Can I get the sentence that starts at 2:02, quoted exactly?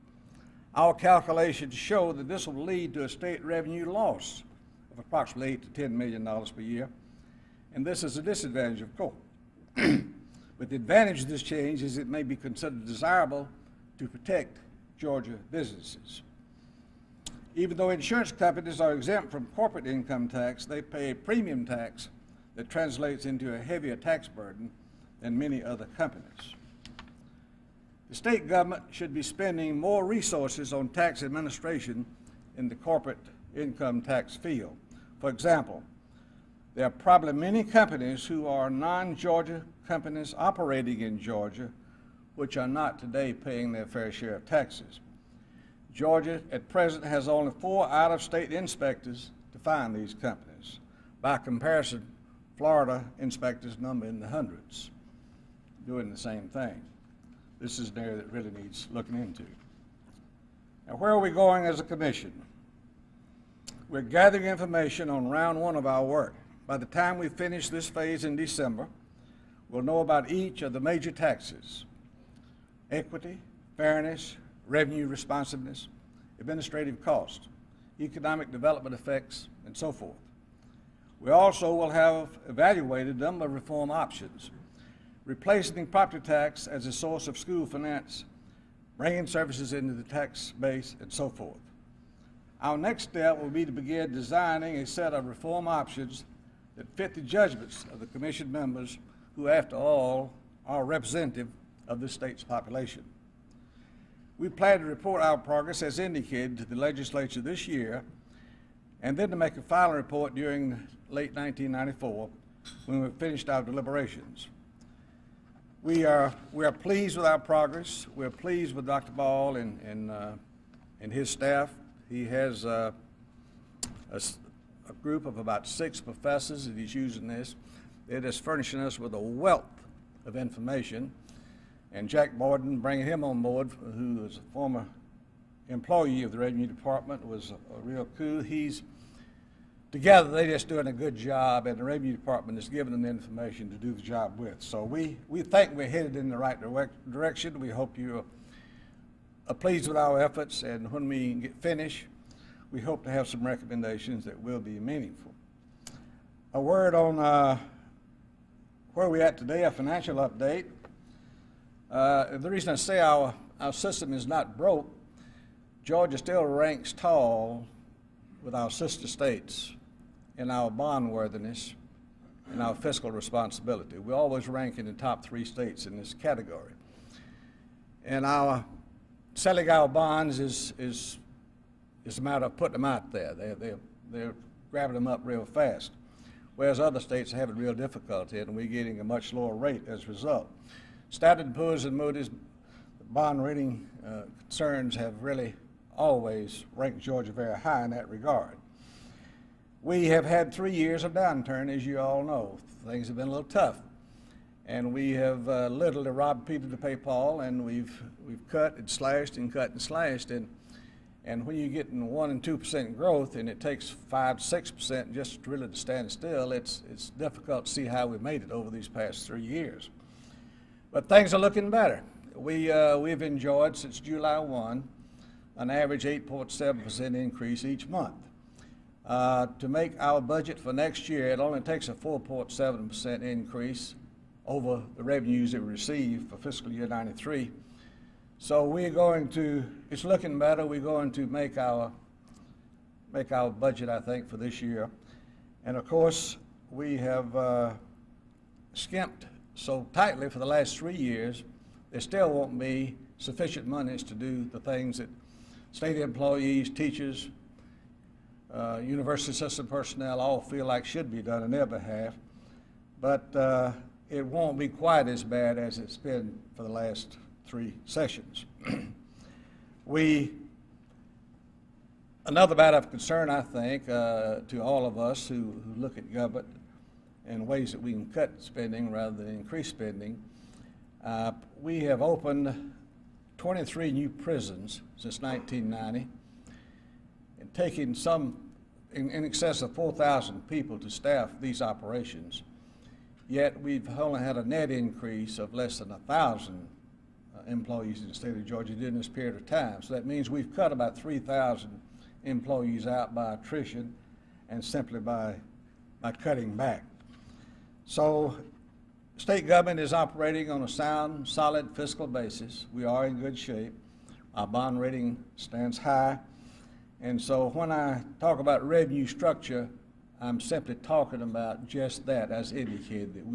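He has uh, a, a, group of about six professors that he's using this.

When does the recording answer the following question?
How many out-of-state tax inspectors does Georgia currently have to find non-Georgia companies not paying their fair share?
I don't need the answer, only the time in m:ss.
0:47.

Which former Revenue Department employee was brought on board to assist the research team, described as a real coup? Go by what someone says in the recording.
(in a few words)
Jack Borden.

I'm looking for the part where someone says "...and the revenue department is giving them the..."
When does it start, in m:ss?
2:21.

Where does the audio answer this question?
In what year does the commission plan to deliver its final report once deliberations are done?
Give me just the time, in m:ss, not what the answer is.
1:51.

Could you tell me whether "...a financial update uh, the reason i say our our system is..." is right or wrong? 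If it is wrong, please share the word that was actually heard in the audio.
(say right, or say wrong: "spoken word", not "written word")
right.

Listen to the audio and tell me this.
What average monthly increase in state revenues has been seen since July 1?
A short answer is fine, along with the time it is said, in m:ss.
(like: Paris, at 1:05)
8.7%, at 3:46.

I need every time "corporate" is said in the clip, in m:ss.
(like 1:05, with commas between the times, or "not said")
0:19, 0:32.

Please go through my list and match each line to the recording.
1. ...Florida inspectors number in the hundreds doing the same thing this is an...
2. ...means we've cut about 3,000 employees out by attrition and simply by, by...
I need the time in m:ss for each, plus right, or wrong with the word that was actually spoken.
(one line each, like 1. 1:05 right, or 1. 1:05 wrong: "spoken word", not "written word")
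1. 0:52 right
2. 5:00 right.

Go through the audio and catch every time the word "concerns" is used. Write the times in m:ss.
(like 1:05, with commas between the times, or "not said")
3:14, 4:32.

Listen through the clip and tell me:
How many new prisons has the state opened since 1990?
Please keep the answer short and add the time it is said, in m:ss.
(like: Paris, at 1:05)
23, at 4:43.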